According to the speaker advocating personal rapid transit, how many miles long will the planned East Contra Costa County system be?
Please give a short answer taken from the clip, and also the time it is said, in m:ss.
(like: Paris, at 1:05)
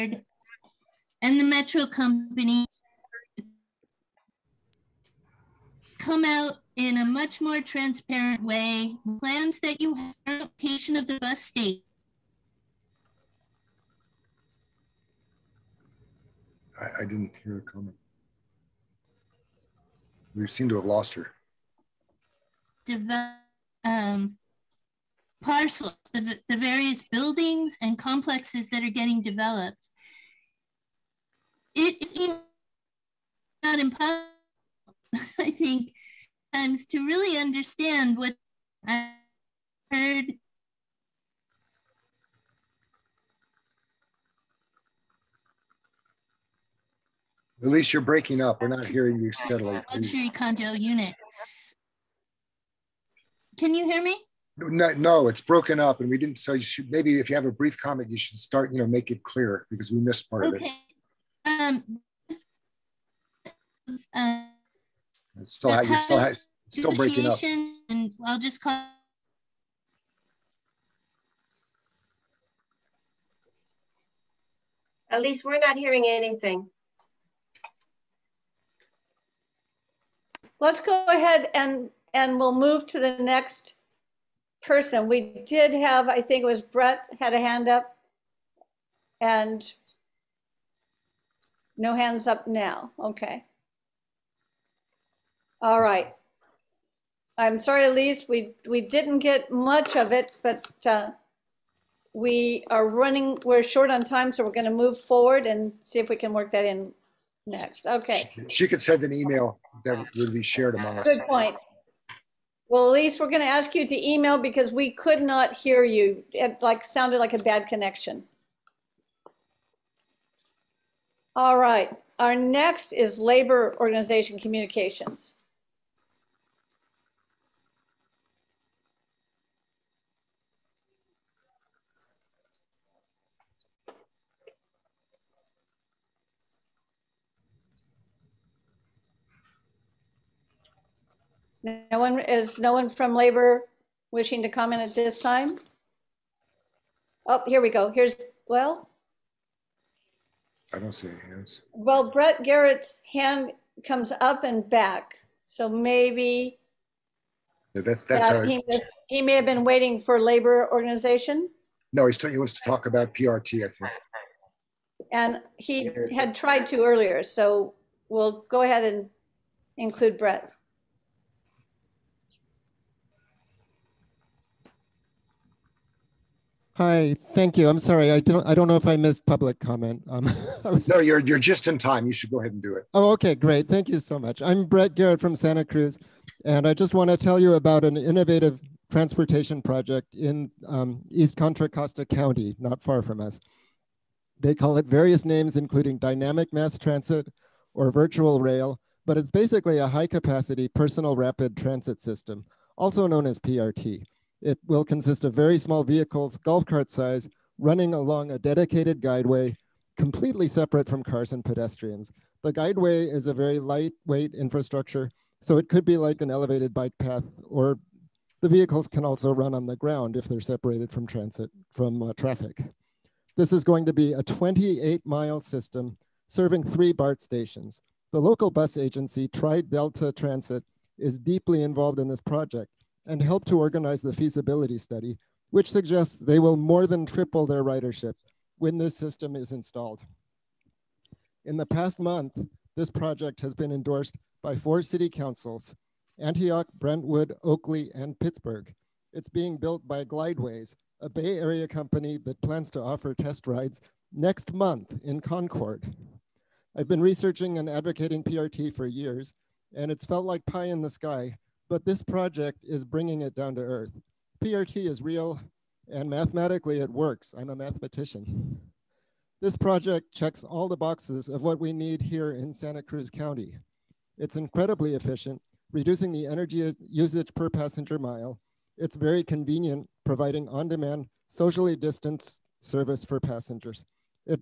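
28, at 3:44.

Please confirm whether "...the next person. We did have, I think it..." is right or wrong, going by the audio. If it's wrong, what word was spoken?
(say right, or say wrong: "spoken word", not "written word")
right.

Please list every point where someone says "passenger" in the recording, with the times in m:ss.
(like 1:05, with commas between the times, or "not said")
4:37, 4:43.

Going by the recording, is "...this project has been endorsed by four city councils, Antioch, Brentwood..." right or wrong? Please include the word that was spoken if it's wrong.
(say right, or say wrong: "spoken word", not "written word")
right.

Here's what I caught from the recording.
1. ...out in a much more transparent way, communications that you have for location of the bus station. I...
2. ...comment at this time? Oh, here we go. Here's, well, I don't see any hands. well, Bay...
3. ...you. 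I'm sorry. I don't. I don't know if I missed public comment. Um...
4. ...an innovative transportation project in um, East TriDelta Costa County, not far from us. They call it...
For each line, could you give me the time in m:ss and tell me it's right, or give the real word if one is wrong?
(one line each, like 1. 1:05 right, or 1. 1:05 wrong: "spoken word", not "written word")
1. 0:06 wrong: "plans", not "communications"
2. 2:24 wrong: "Brett", not "Bay"
3. 2:57 right
4. 3:07 wrong: "Contra", not "TriDelta".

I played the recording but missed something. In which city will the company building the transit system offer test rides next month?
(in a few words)
Concord.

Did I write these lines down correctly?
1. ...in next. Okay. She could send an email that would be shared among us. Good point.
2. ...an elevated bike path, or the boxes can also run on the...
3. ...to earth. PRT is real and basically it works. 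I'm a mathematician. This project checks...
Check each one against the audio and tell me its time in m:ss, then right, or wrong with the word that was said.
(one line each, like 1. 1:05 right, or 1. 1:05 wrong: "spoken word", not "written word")
1. 1:46 right
2. 3:36 wrong: "vehicles", not "boxes"
3. 4:23 wrong: "mathematically", not "basically".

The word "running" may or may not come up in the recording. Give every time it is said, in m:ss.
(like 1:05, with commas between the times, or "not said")
1:42, 3:27.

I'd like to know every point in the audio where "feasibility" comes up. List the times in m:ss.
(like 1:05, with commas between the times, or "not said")
3:54.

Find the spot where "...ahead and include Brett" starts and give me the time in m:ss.
2:48.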